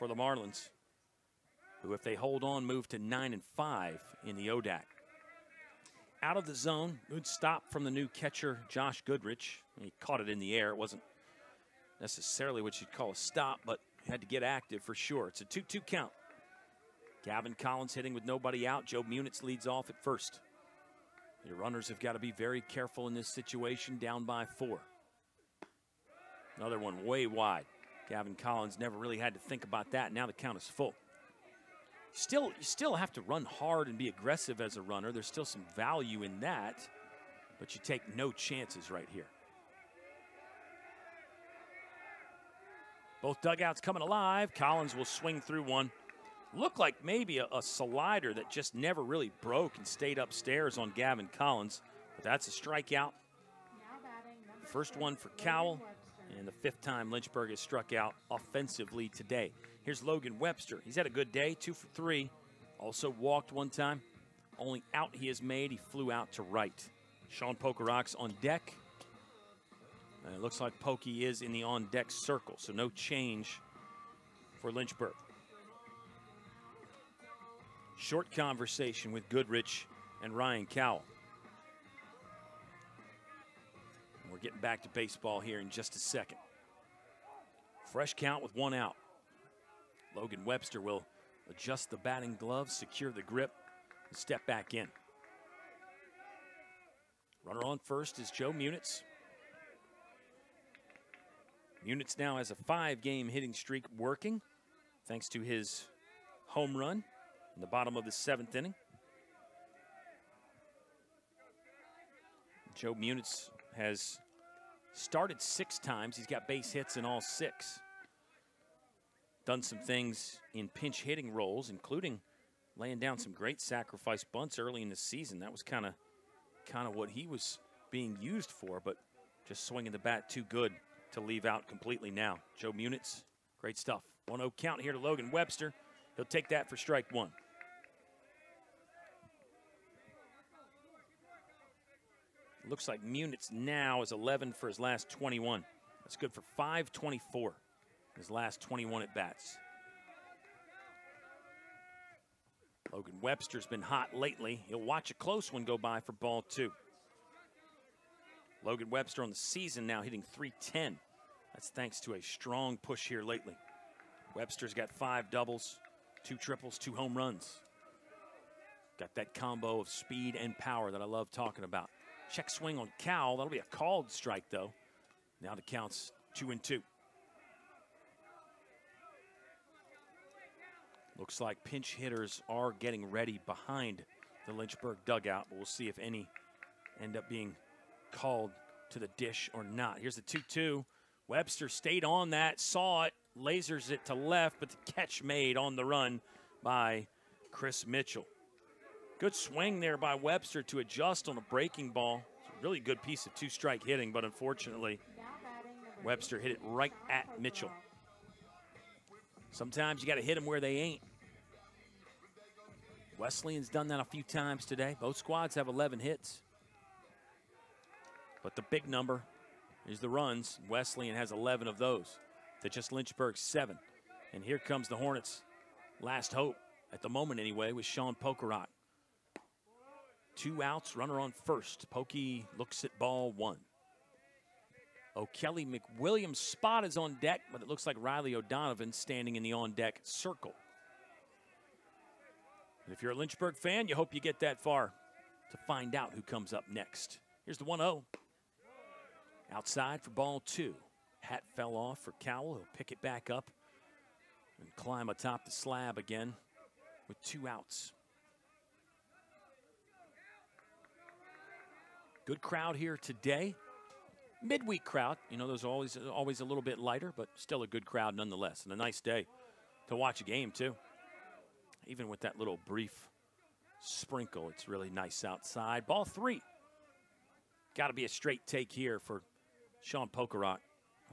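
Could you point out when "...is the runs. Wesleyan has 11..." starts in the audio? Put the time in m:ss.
3:39.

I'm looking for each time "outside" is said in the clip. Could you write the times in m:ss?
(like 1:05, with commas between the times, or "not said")
4:09, 4:35.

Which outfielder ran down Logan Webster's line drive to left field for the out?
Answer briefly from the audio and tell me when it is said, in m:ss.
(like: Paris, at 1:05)
Chris Mitchell, at 3:17.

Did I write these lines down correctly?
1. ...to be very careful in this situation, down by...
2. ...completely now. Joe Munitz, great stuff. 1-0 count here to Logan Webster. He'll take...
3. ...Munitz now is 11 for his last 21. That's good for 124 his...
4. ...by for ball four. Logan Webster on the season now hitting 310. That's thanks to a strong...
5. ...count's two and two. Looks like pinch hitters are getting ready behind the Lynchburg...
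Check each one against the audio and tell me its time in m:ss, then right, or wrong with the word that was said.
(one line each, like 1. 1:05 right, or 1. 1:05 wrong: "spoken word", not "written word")
1. 0:22 right
2. 2:11 right
3. 2:23 wrong: "524", not "124"
4. 2:35 wrong: "two", not "four"
5. 2:55 right.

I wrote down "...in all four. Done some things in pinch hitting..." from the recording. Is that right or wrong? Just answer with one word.
wrong.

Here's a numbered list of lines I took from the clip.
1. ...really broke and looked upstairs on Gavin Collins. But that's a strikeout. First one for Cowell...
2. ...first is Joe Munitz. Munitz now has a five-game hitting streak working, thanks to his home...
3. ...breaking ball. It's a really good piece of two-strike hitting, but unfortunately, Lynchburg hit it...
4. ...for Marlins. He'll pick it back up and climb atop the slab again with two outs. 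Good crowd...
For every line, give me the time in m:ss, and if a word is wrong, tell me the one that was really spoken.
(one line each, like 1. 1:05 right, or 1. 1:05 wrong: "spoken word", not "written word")
1. 0:49 wrong: "stayed", not "looked"
2. 1:37 right
3. 3:21 wrong: "Webster", not "Lynchburg"
4. 4:11 wrong: "Cowell", not "Marlins".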